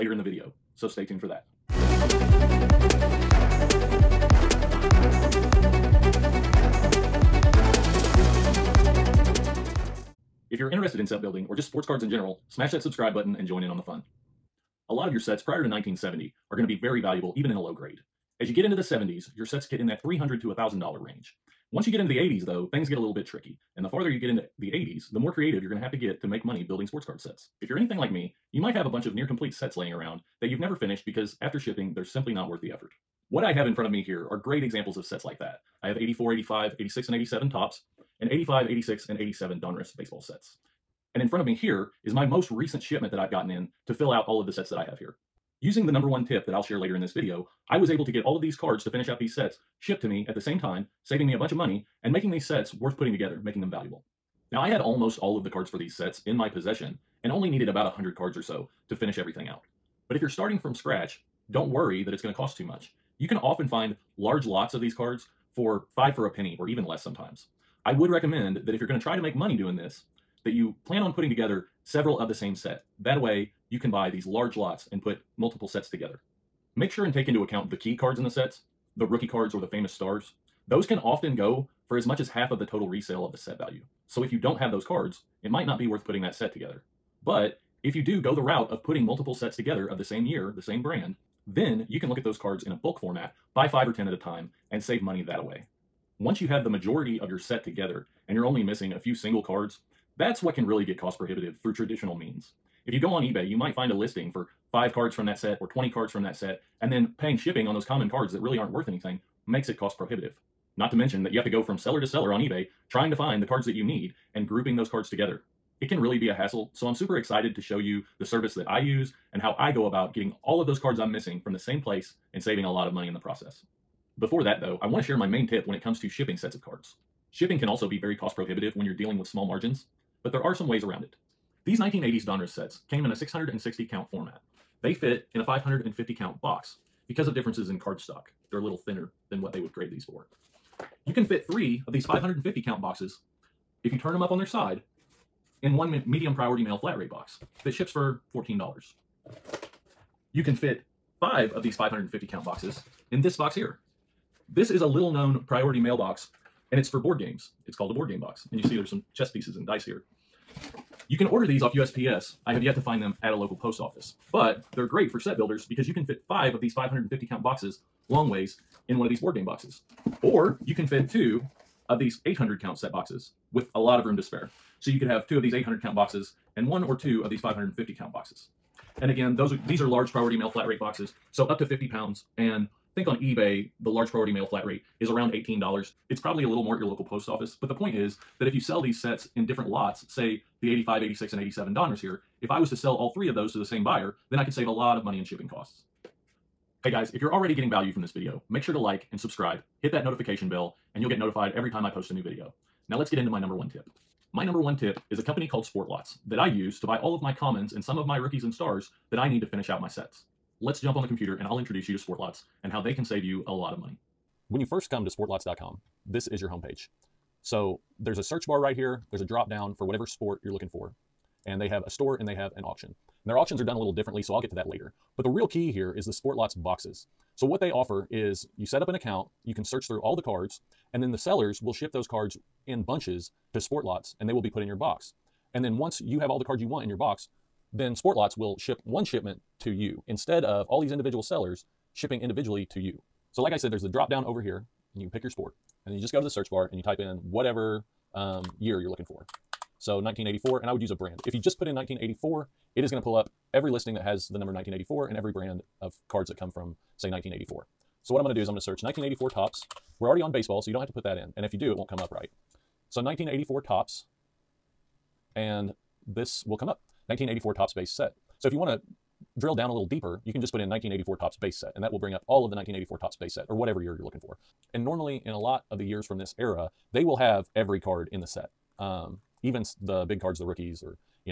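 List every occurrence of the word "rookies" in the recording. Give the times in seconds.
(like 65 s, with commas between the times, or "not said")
79 s, 208 s, 280 s.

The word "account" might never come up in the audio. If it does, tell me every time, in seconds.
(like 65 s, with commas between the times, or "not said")
77 s, 228 s.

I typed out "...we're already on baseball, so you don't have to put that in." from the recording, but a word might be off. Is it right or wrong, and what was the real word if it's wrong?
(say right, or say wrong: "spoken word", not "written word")
right.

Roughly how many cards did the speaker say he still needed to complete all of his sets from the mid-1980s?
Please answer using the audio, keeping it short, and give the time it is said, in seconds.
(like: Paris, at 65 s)
100, at 57 s.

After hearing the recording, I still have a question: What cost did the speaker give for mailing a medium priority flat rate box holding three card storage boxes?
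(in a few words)
$14.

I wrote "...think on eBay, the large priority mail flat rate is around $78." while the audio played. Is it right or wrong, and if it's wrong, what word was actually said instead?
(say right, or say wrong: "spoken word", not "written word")
wrong: "18", not "78".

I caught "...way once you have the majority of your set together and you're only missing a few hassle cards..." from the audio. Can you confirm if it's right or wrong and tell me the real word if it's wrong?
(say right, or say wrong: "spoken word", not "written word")
wrong: "single", not "hassle".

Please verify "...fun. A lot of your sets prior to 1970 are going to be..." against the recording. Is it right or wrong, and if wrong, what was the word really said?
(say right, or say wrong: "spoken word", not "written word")
right.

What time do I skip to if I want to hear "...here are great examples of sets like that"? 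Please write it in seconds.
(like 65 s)
34 s.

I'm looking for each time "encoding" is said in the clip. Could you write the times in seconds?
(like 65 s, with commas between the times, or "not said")
not said.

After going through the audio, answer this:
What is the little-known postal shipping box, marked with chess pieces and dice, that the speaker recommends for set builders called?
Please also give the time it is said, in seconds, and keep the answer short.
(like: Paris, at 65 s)
Board game box, at 157 s.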